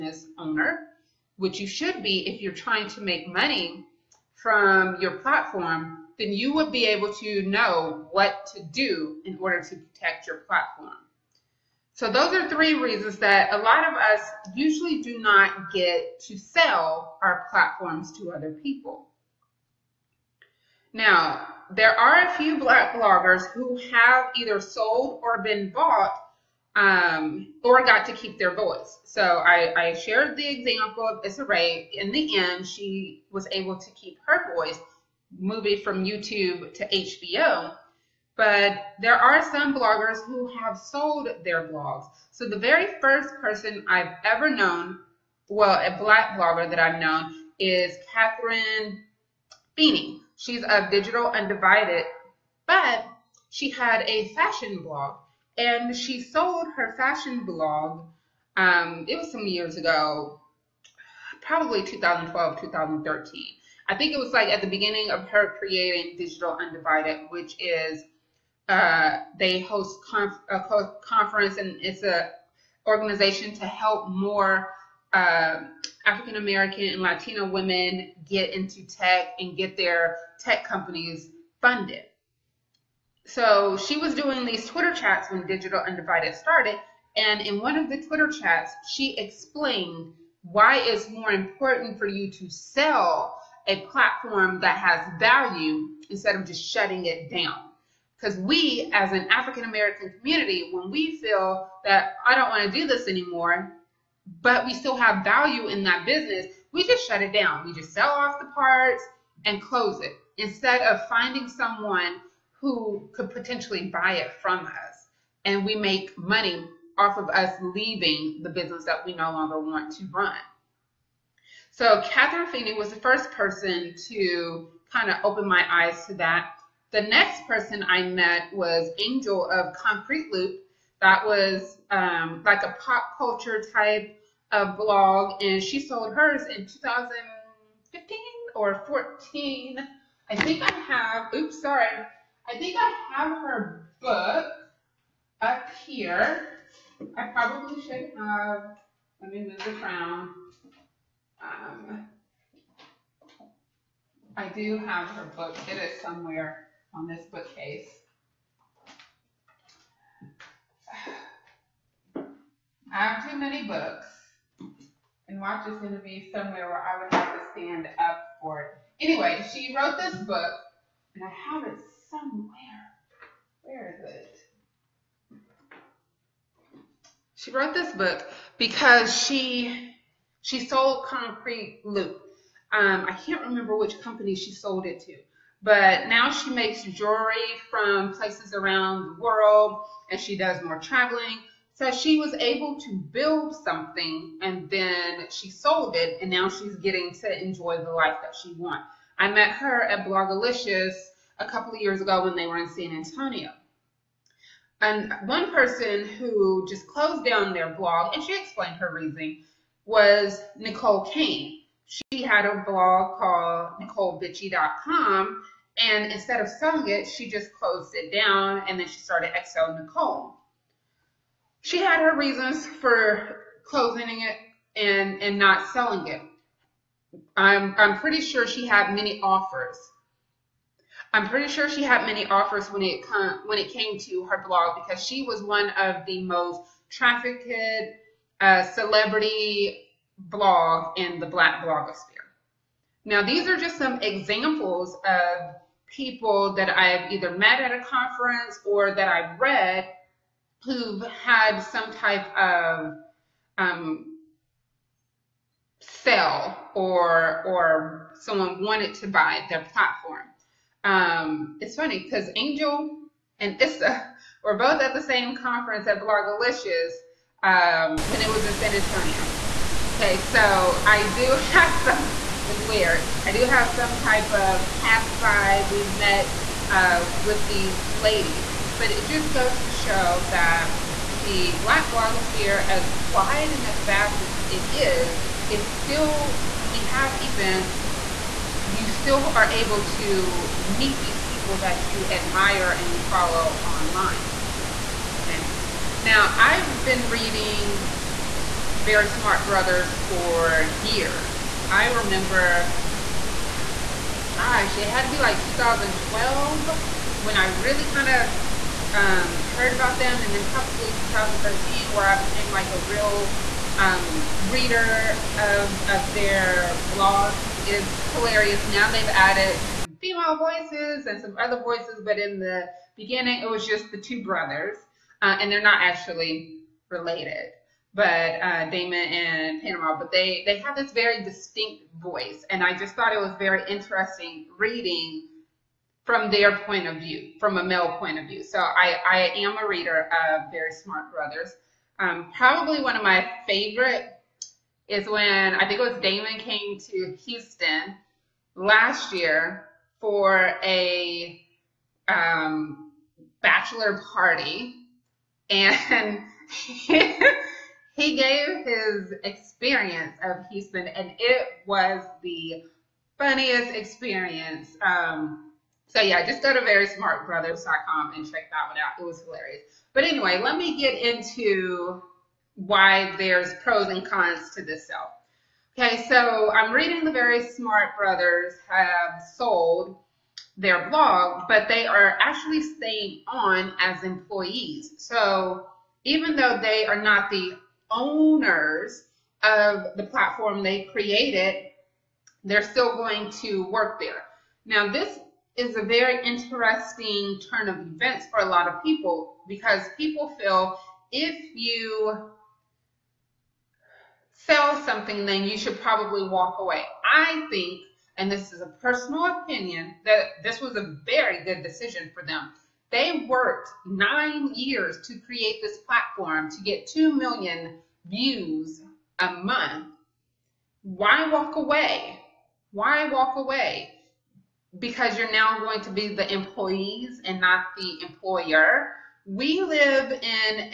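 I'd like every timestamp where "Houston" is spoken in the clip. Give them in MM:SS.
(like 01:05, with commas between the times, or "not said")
05:47, 06:00.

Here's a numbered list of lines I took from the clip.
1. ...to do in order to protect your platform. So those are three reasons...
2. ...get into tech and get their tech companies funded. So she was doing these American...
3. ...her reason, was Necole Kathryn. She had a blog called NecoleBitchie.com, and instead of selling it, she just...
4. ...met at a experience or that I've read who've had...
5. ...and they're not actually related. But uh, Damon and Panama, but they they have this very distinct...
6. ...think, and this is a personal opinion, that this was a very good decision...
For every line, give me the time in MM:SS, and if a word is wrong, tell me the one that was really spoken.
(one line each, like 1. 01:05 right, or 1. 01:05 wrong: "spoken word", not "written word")
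1. 00:08 right
2. 01:18 wrong: "Twitter", not "American"
3. 03:28 wrong: "Kane", not "Kathryn"
4. 04:07 wrong: "conference", not "experience"
5. 05:25 right
6. 06:47 right.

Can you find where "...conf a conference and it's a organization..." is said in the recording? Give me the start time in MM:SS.
01:10.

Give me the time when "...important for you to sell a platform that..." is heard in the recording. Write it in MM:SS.
01:31.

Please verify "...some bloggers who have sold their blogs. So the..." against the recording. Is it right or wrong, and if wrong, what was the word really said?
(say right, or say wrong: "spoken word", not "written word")
right.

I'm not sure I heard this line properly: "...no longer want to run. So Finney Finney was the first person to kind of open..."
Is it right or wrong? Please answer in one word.
wrong.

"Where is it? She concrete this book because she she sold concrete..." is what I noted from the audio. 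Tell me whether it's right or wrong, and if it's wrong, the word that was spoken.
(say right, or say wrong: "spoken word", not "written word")
wrong: "wrote", not "concrete".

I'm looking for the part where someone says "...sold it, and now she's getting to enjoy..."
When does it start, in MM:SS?
03:15.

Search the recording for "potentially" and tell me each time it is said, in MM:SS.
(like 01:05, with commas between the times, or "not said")
01:53.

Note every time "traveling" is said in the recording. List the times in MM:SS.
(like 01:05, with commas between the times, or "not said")
03:10.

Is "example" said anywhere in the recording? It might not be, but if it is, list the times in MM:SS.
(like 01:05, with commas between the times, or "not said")
00:30, 04:04.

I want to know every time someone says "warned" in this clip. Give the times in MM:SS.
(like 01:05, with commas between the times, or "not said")
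not said.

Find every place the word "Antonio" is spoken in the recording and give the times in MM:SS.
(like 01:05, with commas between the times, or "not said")
03:22, 04:28.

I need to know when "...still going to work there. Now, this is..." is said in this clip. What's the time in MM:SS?
06:32.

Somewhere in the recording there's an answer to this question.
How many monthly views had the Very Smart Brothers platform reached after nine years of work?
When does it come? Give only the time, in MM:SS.
06:56.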